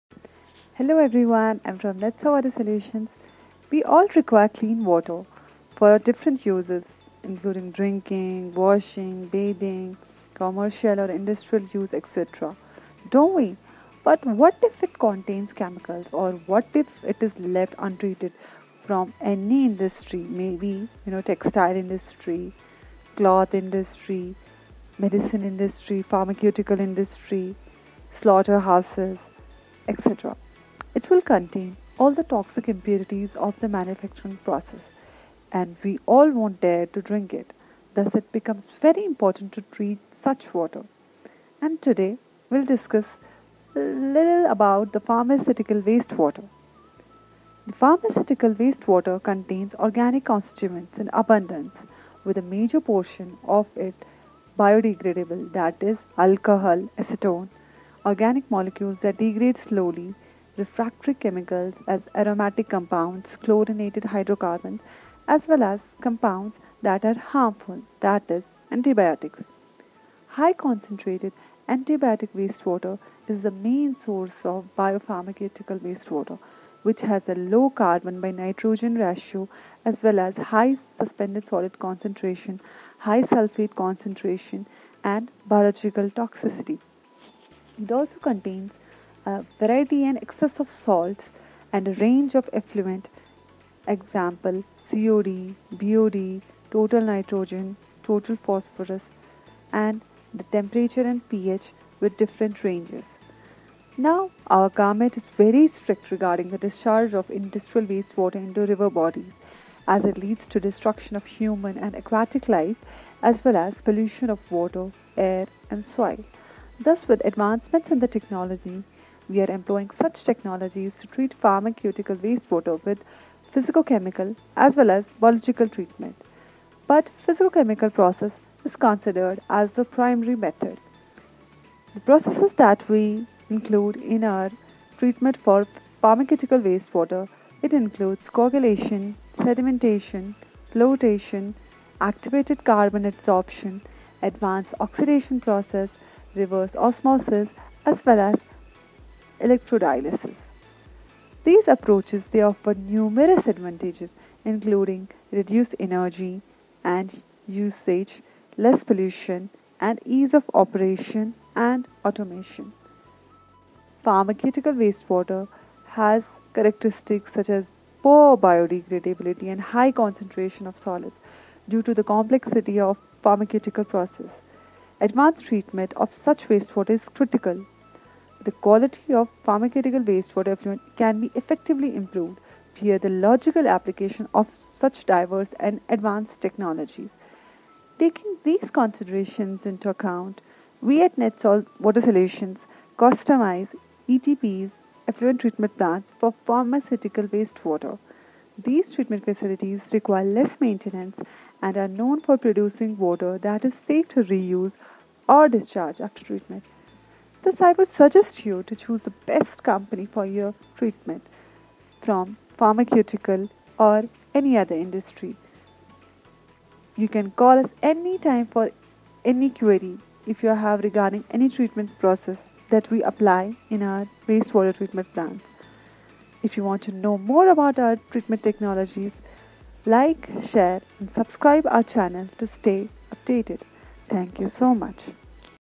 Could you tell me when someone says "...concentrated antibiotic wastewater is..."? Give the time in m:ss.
1:10.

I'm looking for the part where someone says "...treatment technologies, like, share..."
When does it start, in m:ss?
3:47.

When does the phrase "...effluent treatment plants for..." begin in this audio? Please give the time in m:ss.
3:15.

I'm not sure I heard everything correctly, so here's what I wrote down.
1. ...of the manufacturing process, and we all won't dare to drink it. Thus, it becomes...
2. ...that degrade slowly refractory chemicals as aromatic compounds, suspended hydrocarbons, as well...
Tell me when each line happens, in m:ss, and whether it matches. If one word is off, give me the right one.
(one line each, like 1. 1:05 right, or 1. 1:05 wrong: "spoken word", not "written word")
1. 0:33 right
2. 0:59 wrong: "chlorinated", not "suspended".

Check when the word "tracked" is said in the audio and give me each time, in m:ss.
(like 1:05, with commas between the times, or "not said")
not said.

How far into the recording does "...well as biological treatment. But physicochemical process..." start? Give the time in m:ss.
2:04.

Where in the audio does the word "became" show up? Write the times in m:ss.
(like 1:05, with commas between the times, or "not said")
not said.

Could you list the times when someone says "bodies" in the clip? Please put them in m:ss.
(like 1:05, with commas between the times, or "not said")
1:48.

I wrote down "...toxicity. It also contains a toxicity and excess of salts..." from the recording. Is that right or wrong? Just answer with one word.
wrong.